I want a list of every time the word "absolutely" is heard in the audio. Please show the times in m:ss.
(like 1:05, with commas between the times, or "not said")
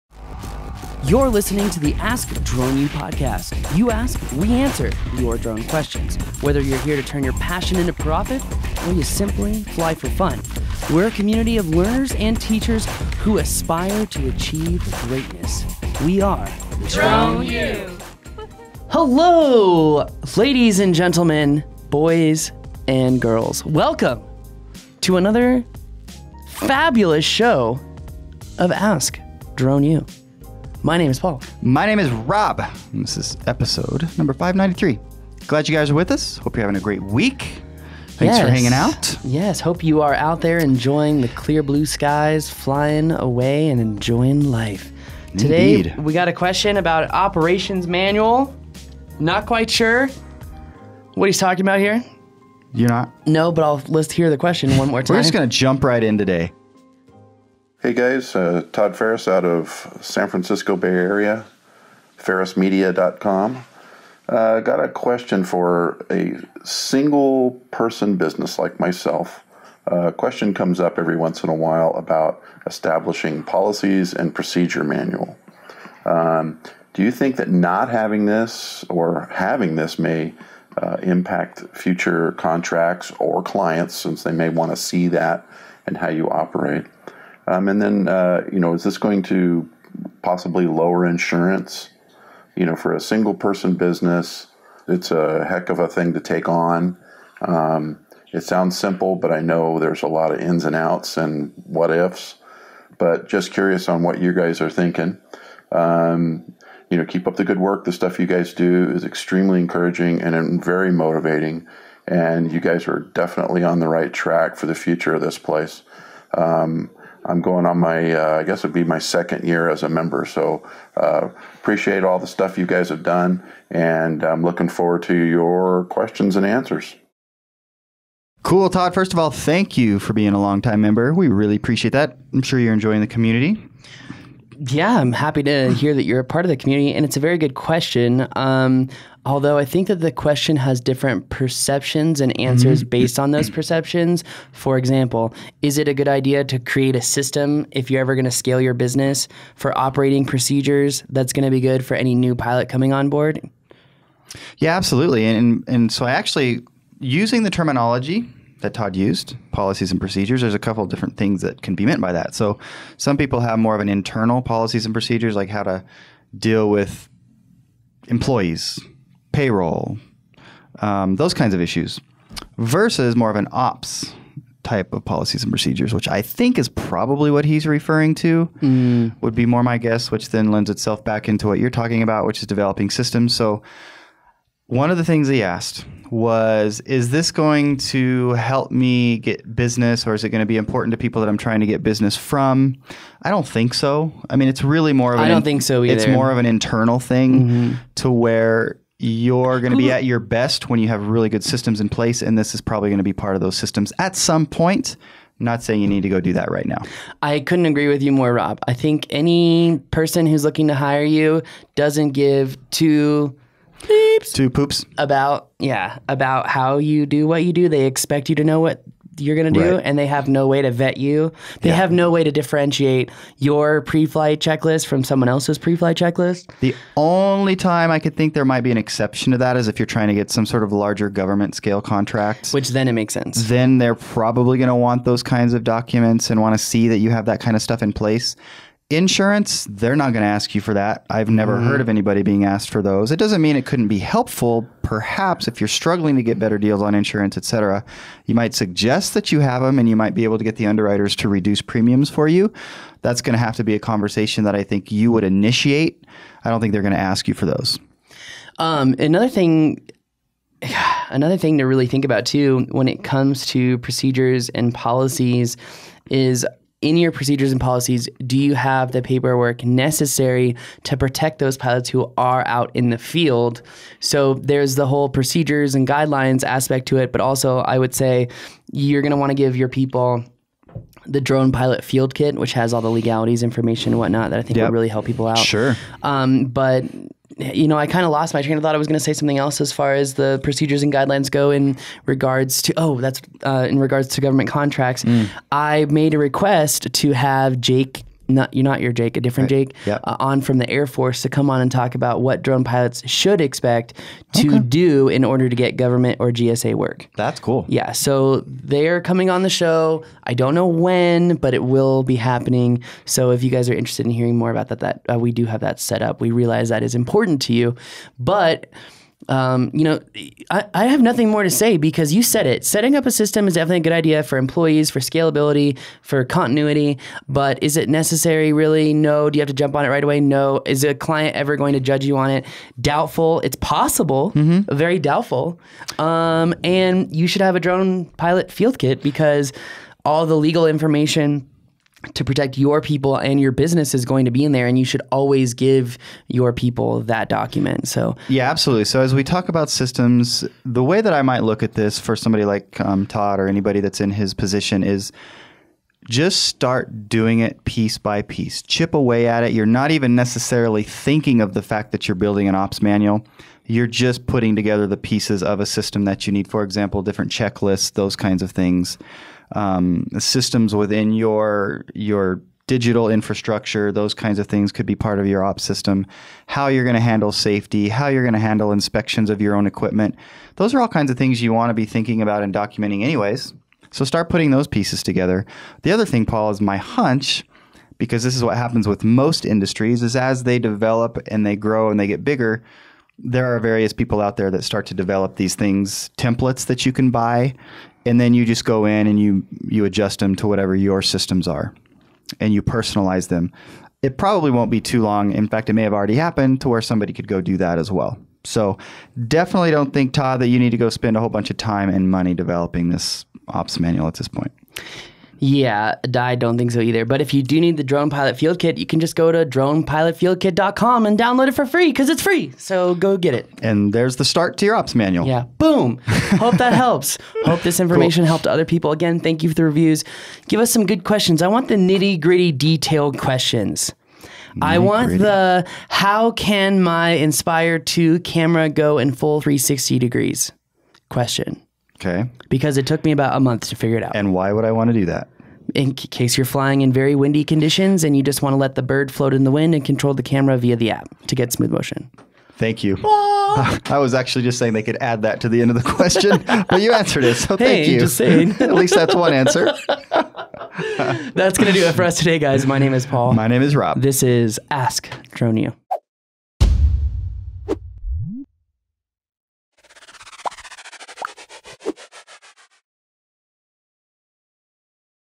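2:34, 5:48.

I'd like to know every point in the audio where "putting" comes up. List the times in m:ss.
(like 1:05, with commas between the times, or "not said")
6:04, 6:24.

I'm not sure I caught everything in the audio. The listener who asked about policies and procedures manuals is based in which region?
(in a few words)
San Francisco Bay Area.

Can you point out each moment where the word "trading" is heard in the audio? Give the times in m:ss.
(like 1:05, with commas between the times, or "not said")
not said.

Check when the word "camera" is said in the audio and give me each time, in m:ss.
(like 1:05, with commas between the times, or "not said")
7:18, 7:30.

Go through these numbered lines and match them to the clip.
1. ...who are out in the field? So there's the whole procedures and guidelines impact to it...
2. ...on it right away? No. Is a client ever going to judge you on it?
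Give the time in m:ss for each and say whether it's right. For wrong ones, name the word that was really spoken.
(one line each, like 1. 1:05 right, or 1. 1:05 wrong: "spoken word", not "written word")
1. 4:31 wrong: "aspect", not "impact"
2. 5:29 right.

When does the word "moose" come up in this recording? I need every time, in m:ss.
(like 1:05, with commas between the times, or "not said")
not said.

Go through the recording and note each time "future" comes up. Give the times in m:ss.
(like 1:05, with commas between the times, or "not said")
1:21, 1:54.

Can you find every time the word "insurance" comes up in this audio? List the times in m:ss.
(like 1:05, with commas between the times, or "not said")
1:31, 3:58, 4:06.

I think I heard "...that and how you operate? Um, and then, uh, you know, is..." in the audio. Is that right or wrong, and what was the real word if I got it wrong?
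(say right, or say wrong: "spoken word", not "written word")
right.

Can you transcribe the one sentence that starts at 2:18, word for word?
Um, Although I think that the question has different perceptions and answers mm-hmm.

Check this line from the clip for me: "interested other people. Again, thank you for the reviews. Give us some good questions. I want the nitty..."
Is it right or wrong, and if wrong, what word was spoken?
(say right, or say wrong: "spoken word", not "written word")
wrong: "helped", not "interested".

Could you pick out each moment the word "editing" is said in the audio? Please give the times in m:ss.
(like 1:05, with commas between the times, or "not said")
not said.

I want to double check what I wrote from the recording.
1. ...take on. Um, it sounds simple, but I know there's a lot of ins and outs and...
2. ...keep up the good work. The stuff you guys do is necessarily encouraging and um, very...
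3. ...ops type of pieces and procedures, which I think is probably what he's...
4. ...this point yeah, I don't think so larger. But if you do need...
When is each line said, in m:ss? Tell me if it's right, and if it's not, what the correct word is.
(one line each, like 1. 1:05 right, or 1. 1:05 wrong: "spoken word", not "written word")
1. 1:36 right
2. 1:47 wrong: "extremely", not "necessarily"
3. 2:53 wrong: "policies", not "pieces"
4. 6:54 wrong: "either", not "larger".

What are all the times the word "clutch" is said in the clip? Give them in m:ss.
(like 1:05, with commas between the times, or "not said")
not said.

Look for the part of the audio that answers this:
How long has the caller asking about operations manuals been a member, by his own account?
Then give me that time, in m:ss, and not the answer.
1:58.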